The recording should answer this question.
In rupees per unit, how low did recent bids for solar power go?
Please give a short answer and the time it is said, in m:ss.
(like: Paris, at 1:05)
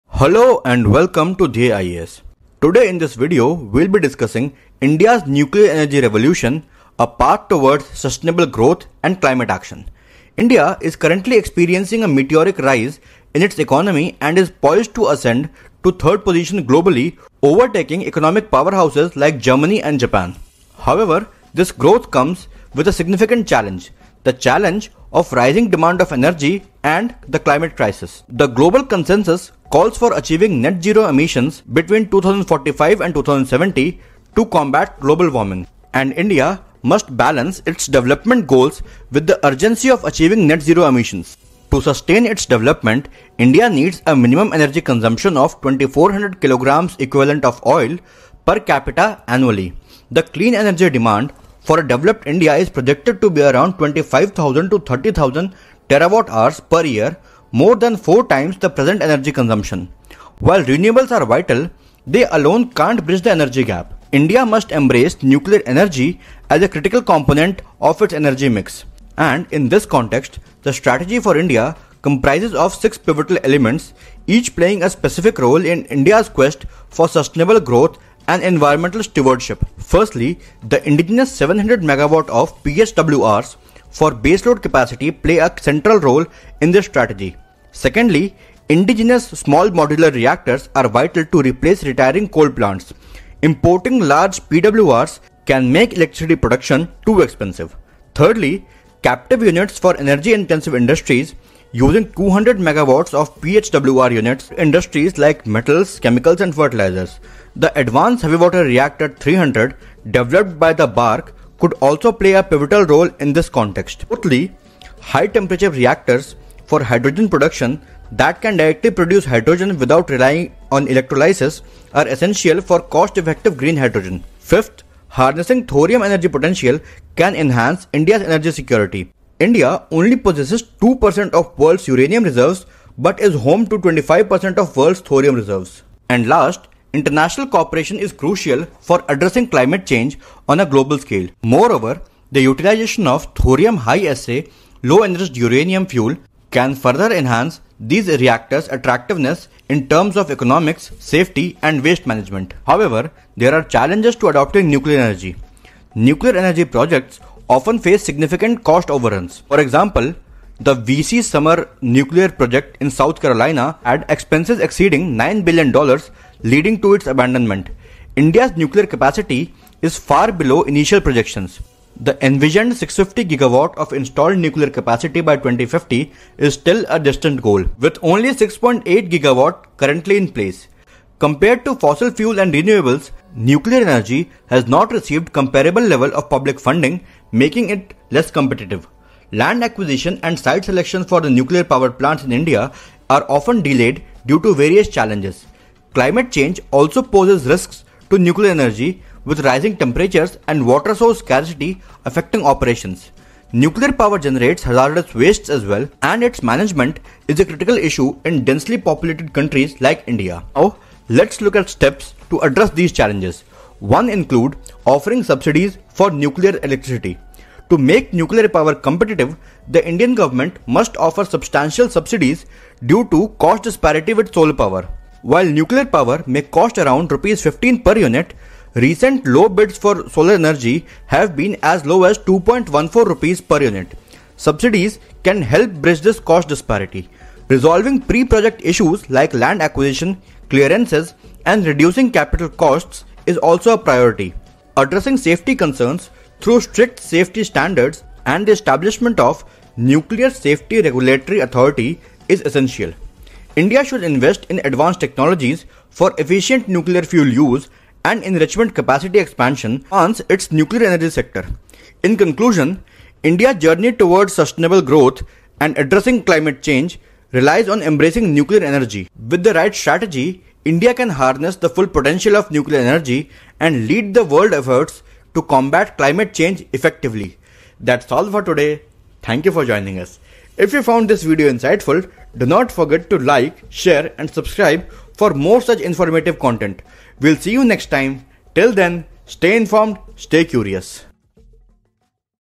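2.14 rupees, at 3:52.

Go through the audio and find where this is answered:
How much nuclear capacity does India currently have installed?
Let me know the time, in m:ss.
2:58.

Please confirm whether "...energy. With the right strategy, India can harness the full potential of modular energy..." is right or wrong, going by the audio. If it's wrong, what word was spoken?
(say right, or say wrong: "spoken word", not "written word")
wrong: "nuclear", not "modular".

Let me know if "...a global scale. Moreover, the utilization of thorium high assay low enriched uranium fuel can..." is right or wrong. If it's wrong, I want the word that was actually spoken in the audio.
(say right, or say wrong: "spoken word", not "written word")
right.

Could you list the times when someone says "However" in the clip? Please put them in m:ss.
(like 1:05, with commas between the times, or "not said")
0:20, 2:32.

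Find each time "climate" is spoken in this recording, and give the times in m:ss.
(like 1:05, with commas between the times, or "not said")
0:09, 0:27, 2:19, 3:15, 4:26, 4:35.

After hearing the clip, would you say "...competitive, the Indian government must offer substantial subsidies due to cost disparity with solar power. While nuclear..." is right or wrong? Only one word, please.
right.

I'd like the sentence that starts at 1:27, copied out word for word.
Secondly, indigenous small modular reactors are vital to replace retiring coal plants.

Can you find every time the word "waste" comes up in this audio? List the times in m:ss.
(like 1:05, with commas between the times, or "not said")
2:31, 3:25.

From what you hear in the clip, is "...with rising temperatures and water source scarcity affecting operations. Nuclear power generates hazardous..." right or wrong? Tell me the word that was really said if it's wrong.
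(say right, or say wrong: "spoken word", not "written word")
right.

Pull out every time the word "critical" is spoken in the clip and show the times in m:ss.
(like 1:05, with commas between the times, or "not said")
1:06, 3:27.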